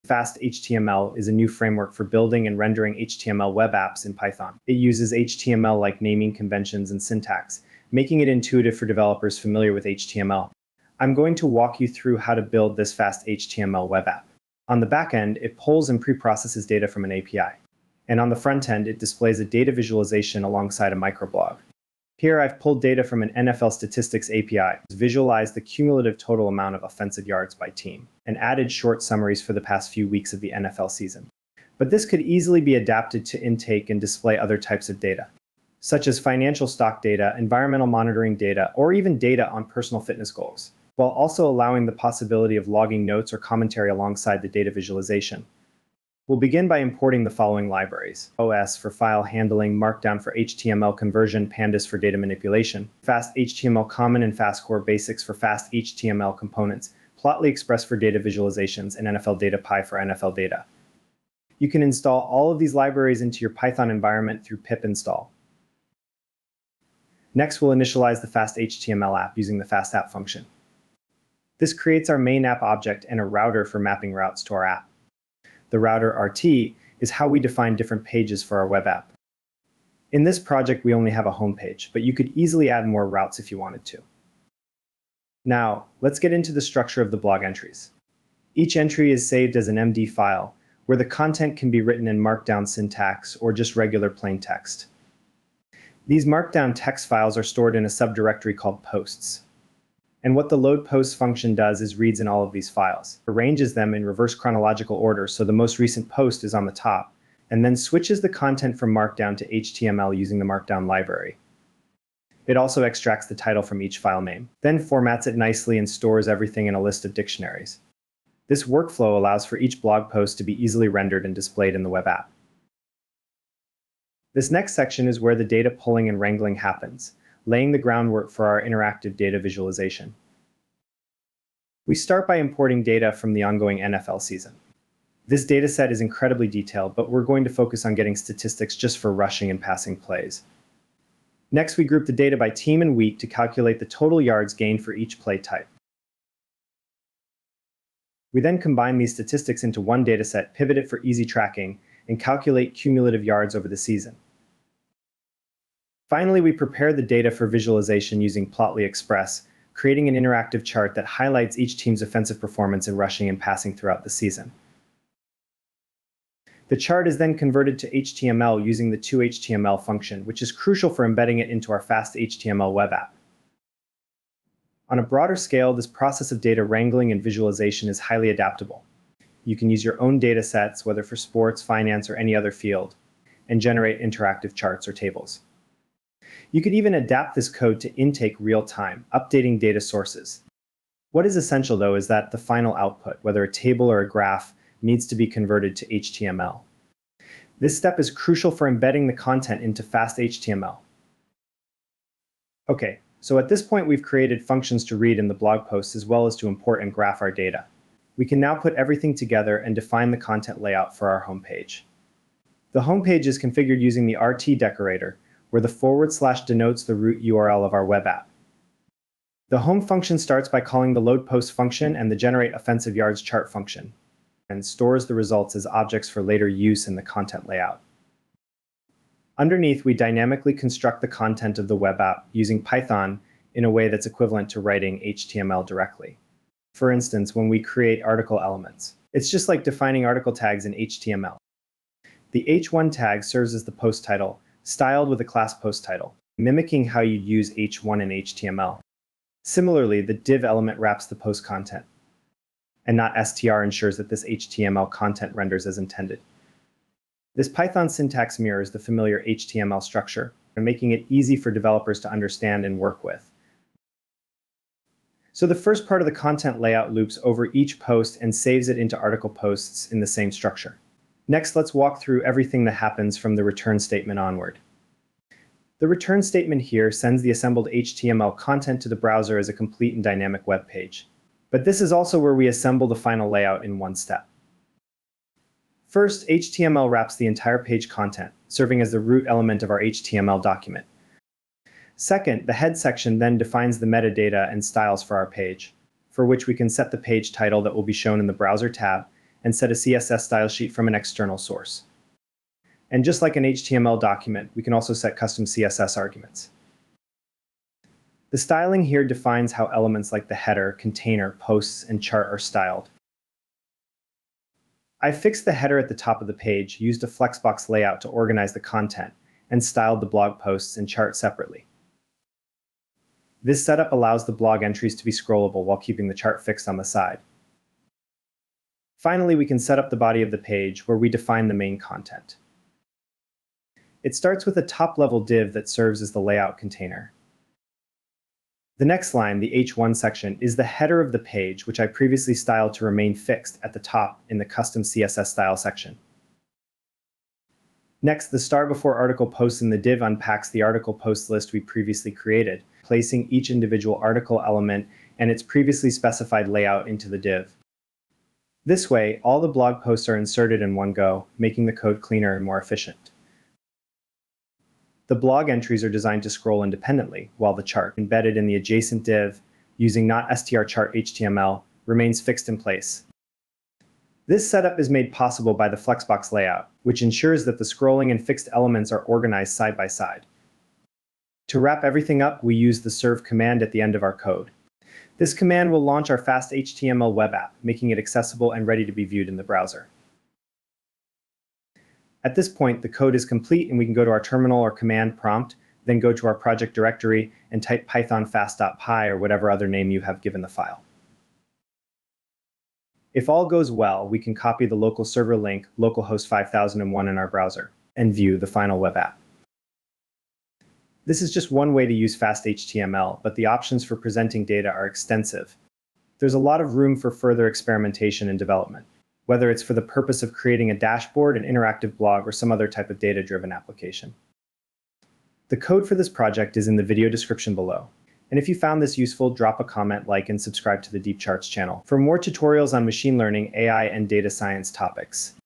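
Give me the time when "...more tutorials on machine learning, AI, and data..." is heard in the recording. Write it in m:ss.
7:11.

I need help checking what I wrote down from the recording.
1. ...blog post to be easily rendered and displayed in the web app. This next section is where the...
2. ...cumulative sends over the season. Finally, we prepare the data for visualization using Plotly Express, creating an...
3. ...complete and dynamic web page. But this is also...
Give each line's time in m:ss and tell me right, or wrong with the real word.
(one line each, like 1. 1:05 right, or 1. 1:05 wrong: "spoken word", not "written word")
1. 1:59 right
2. 2:32 wrong: "yards", not "sends"
3. 4:39 right.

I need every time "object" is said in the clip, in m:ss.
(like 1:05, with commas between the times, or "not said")
1:12, 3:45.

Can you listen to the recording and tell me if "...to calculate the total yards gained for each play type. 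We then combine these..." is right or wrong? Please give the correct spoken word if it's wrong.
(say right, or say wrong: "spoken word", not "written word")
right.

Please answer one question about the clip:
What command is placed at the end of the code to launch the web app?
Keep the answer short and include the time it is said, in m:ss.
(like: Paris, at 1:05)
serve, at 6:22.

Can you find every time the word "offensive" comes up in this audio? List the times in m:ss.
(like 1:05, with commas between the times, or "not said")
0:26, 2:42, 3:42.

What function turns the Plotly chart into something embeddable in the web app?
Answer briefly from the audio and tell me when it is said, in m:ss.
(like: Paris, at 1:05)
toHTML, at 2:48.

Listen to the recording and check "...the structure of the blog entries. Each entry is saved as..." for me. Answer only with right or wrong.
right.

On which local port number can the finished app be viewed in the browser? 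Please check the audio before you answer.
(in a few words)
5001.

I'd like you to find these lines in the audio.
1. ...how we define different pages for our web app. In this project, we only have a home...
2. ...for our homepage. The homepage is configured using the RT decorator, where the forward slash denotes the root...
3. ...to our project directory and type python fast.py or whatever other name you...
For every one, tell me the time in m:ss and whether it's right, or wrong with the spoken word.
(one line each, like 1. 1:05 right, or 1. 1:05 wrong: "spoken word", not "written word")
1. 1:17 right
2. 3:30 right
3. 6:36 right.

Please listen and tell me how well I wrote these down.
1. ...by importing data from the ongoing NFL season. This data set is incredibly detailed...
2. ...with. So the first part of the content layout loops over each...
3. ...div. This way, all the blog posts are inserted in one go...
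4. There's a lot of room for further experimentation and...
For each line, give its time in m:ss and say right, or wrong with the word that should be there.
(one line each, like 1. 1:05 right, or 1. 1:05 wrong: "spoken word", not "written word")
1. 2:12 right
2. 4:23 right
3. 5:57 right
4. 6:56 right.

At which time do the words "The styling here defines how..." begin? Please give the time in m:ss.
5:08.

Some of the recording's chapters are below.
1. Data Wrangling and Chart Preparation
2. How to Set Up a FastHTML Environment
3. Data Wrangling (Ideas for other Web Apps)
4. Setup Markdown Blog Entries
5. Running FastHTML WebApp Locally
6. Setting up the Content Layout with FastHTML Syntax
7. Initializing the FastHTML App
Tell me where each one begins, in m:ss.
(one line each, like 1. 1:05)
1. 2:04
2. 0:45
3. 2:54
4. 1:25
5. 6:31
6. 3:27
7. 1:07.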